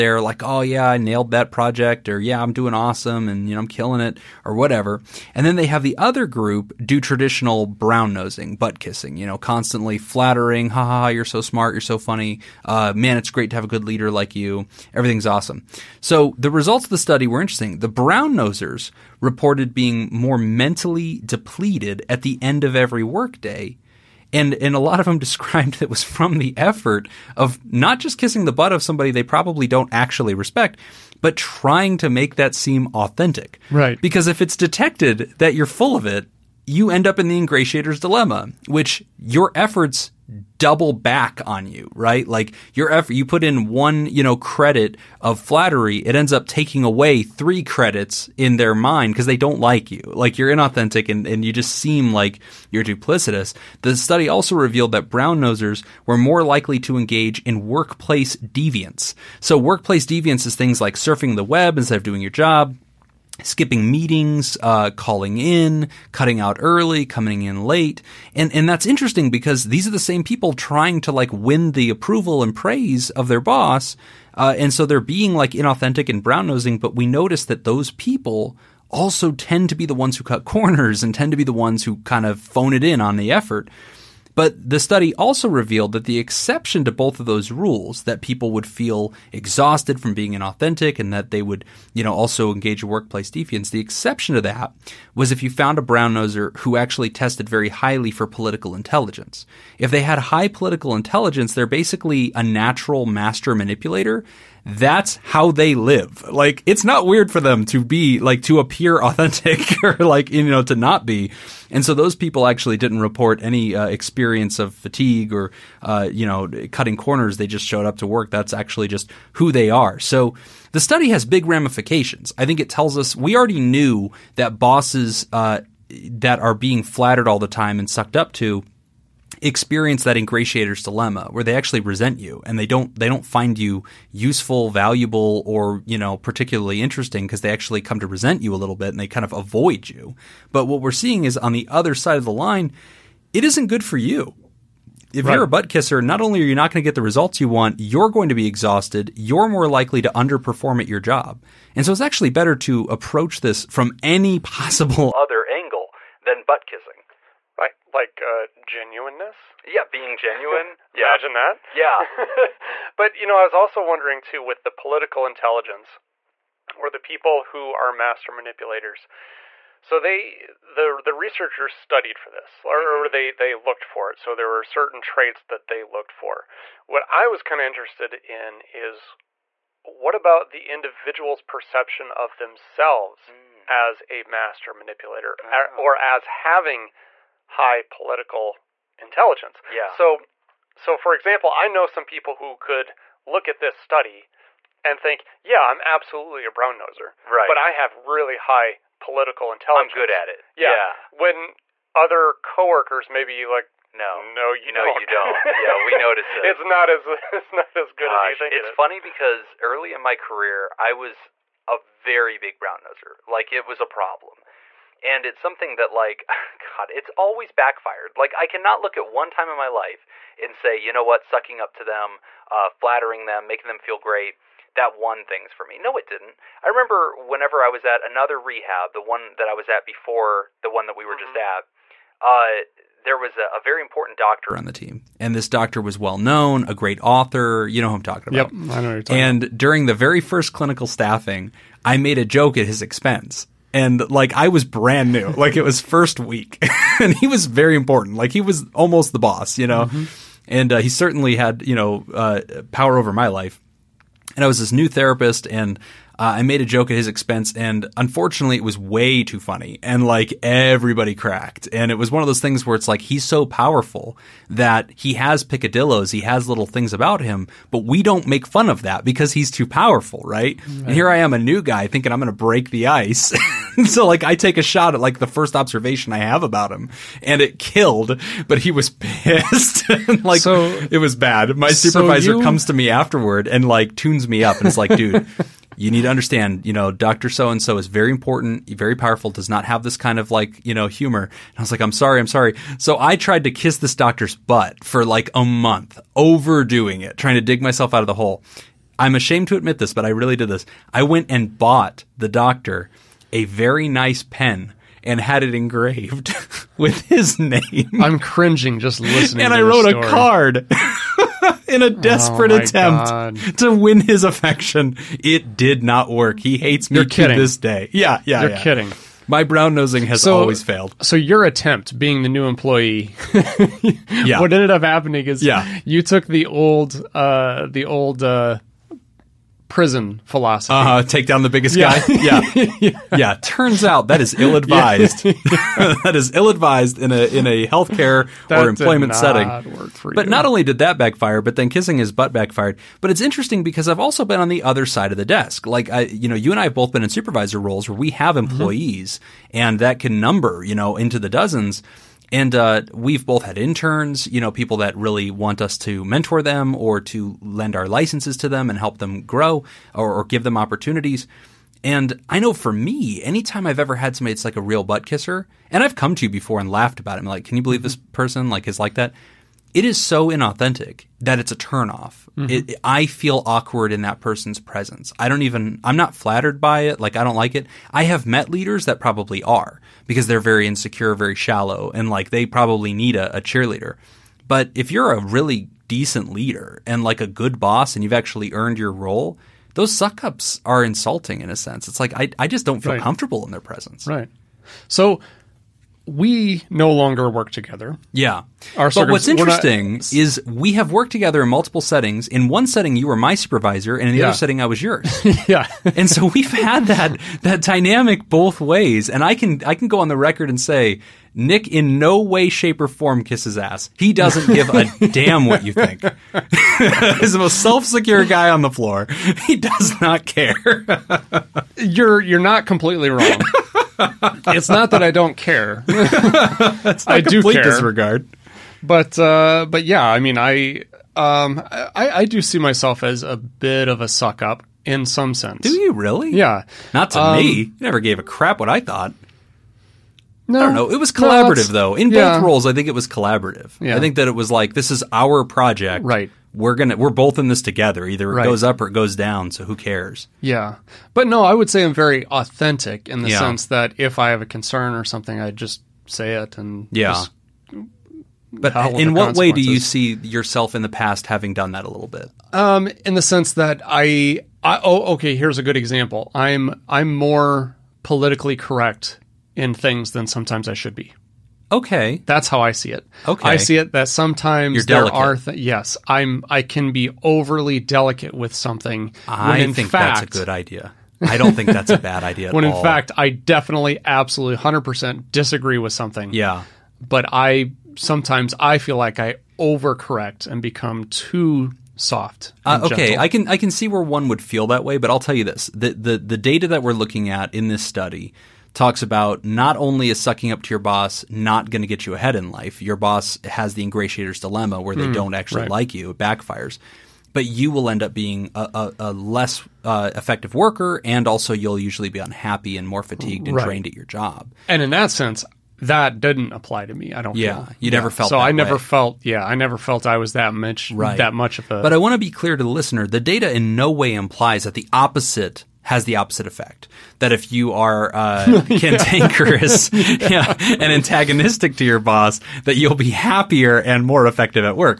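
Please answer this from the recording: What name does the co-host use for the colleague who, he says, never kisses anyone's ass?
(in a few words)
Nick.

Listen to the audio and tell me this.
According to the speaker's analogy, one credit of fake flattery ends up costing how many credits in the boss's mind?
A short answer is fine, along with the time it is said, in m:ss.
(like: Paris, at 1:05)
3, at 0:47.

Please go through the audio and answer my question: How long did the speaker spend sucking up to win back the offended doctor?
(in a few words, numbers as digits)
a month.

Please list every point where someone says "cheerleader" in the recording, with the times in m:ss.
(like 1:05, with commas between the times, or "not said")
6:23.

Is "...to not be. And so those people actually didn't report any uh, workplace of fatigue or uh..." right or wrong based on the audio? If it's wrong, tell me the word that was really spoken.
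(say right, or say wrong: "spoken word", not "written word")
wrong: "experience", not "workplace".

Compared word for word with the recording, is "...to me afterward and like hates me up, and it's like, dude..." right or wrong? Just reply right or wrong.
wrong.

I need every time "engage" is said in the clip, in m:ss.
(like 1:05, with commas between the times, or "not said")
0:56, 1:32.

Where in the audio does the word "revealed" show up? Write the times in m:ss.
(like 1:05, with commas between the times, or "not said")
0:54, 1:25.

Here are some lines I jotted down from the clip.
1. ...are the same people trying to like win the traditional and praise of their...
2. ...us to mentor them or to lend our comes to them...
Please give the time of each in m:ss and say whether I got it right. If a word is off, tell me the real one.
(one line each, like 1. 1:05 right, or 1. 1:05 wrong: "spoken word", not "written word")
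1. 1:09 wrong: "approval", not "traditional"
2. 5:55 wrong: "licenses", not "comes".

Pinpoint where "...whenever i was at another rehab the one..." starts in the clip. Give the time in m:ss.
3:47.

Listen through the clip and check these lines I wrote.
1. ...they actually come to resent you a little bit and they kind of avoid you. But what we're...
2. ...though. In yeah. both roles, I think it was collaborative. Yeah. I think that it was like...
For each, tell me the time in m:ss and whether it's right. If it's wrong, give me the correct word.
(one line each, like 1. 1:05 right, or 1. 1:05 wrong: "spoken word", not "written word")
1. 2:17 right
2. 7:21 right.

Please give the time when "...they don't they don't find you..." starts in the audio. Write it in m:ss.
2:12.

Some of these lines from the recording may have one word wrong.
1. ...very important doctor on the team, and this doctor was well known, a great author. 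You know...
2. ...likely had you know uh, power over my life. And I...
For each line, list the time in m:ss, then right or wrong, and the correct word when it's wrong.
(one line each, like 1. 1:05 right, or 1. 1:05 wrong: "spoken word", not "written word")
1. 3:53 right
2. 4:10 wrong: "certainly", not "likely".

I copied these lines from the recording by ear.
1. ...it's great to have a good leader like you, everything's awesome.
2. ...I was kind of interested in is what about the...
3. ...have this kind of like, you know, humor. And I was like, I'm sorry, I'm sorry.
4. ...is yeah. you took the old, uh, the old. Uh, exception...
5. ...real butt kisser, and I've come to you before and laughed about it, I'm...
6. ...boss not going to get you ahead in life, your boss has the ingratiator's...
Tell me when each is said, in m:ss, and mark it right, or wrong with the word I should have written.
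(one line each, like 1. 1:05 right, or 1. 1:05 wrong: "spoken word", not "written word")
1. 0:13 right
2. 2:57 right
3. 4:49 right
4. 5:25 wrong: "prison", not "exception"
5. 6:04 right
6. 8:20 right.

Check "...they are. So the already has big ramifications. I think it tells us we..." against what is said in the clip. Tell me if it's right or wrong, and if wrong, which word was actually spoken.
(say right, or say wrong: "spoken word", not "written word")
wrong: "study", not "already".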